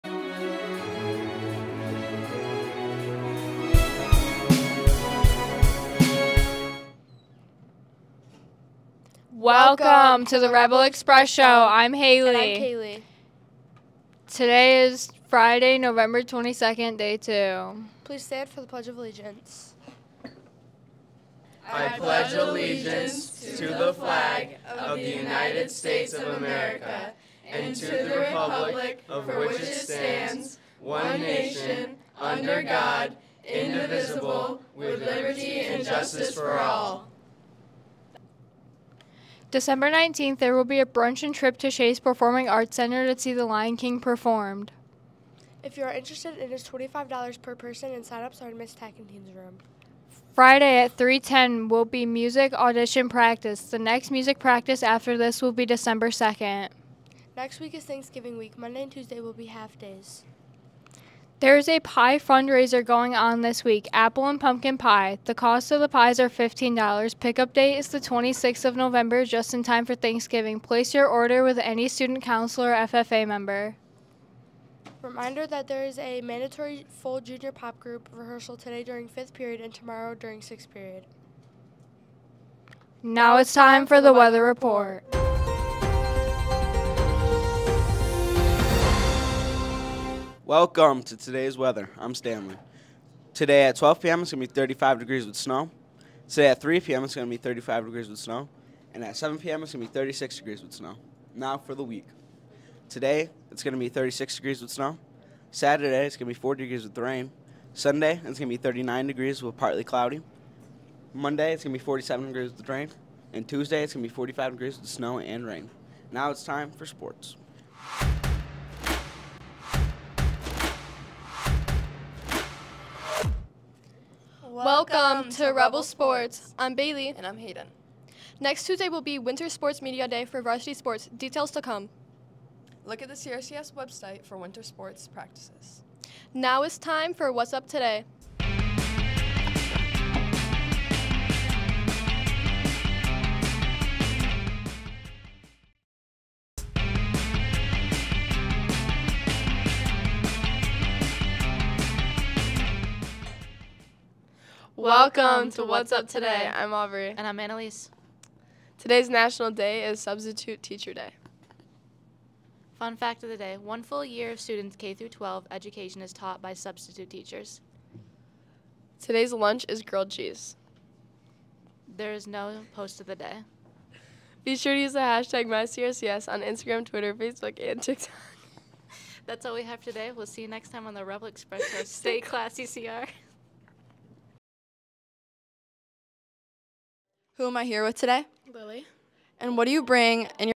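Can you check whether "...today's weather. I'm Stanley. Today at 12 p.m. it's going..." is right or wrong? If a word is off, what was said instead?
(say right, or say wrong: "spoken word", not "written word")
right.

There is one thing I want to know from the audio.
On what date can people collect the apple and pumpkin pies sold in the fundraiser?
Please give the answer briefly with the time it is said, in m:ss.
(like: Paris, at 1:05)
November 26, at 1:07.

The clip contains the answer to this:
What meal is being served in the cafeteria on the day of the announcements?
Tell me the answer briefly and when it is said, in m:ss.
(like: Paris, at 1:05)
Grilled cheese, at 2:49.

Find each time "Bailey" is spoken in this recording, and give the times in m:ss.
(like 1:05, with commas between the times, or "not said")
2:06.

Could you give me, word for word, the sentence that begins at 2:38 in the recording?
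Today's national day is Substitute Teacher Day.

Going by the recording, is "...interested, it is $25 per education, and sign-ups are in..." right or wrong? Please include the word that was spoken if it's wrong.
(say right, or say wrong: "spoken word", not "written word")
wrong: "person", not "education".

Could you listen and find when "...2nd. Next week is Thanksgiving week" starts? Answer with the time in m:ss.
0:56.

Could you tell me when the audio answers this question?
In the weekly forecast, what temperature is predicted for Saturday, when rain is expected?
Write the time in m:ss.
1:46.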